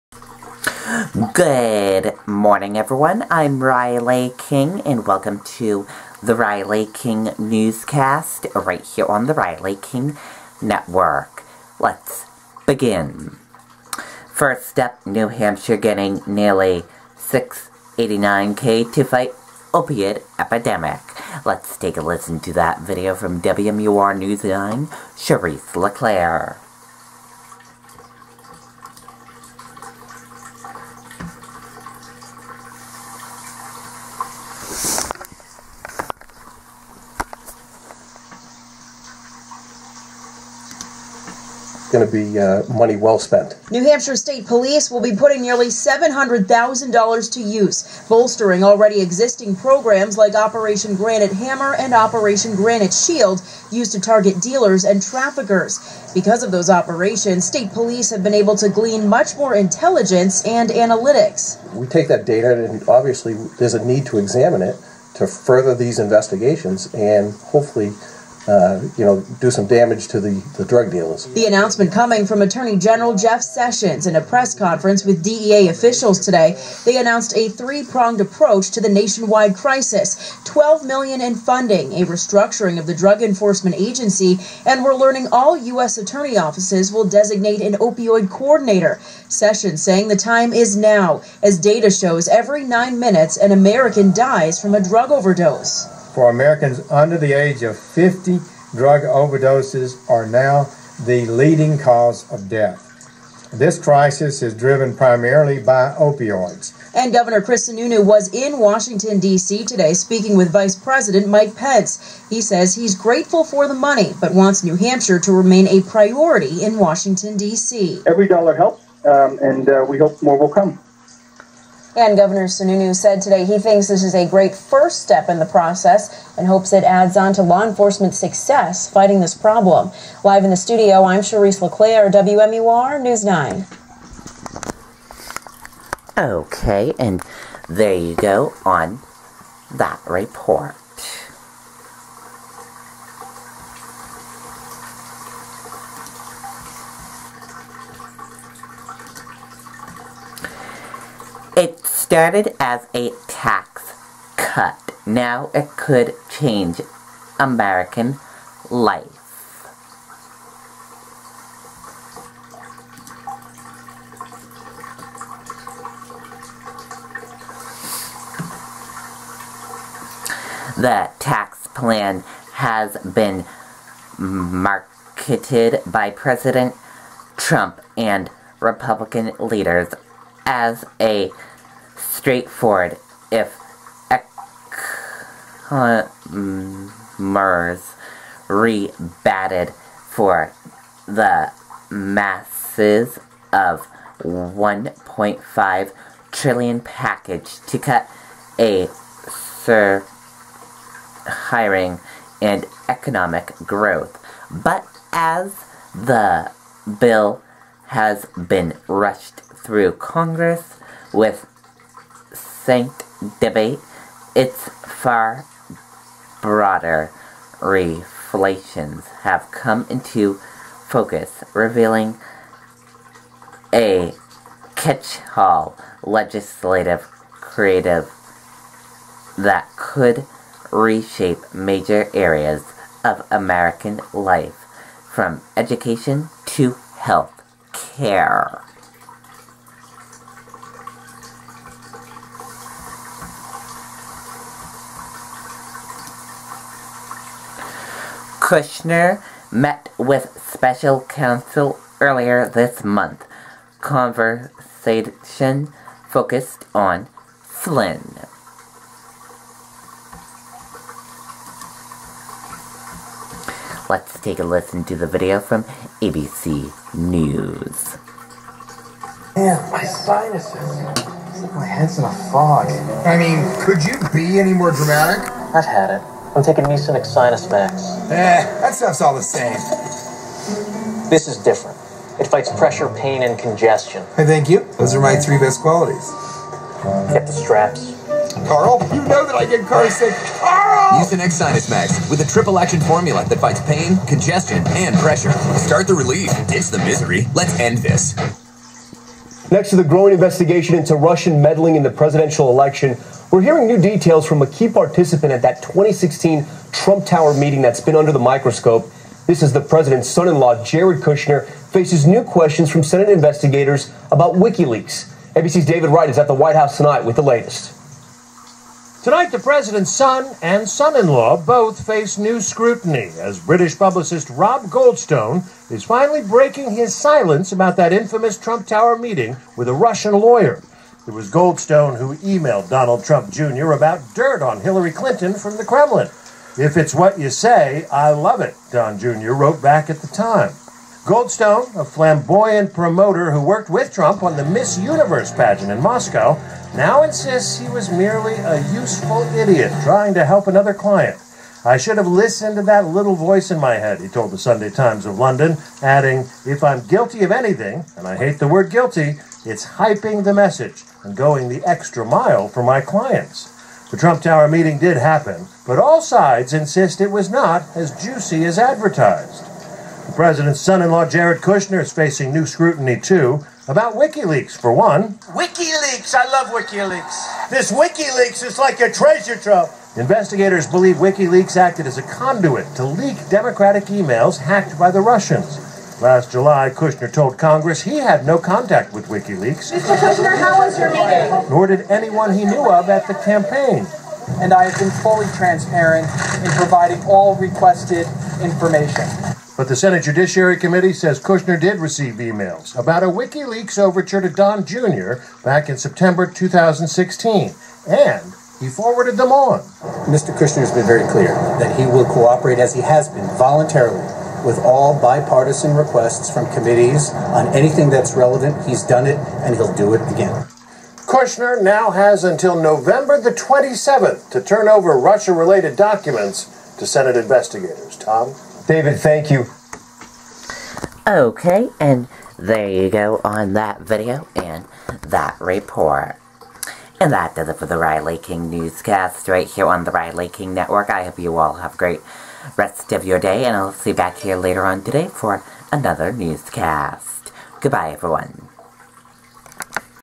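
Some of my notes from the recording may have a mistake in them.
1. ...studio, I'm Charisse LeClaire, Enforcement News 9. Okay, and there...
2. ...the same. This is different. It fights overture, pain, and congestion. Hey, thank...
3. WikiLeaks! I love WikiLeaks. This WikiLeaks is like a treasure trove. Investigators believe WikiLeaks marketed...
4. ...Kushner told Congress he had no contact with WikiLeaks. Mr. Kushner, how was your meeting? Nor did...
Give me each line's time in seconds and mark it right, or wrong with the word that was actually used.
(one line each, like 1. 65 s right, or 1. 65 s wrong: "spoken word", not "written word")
1. 130 s wrong: "WMUR", not "Enforcement"
2. 279 s wrong: "pressure", not "overture"
3. 375 s wrong: "acted", not "marketed"
4. 386 s right.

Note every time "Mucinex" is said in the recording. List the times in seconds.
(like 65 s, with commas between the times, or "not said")
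276 s, 291 s.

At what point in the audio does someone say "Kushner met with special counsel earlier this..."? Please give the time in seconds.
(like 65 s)
248 s.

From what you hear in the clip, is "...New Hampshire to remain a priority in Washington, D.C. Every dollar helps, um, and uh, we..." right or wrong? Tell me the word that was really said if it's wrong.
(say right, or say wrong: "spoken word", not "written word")
right.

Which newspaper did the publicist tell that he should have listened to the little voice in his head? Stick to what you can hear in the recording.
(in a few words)
the Sunday Times of London.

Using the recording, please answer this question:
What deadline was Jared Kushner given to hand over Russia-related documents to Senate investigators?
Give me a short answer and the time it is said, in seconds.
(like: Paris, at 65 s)
November 27, at 422 s.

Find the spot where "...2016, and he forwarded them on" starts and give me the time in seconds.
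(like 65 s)
406 s.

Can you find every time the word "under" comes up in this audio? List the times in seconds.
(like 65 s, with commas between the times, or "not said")
96 s, 307 s.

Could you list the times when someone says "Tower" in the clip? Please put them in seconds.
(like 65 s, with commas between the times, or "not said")
307 s, 328 s, 364 s.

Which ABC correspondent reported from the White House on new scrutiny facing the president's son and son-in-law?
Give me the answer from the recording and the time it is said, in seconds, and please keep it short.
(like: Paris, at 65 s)
David Wright, at 315 s.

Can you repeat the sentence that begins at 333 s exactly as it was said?
about dirt on Hillary Clinton from the Kremlin.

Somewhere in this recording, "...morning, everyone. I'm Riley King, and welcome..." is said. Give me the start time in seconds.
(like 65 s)
2 s.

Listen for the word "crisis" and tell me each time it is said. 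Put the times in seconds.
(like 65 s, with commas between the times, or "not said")
79 s, 103 s.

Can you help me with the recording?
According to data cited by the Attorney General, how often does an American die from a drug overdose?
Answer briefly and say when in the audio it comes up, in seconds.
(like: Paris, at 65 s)
every 9 minutes, at 92 s.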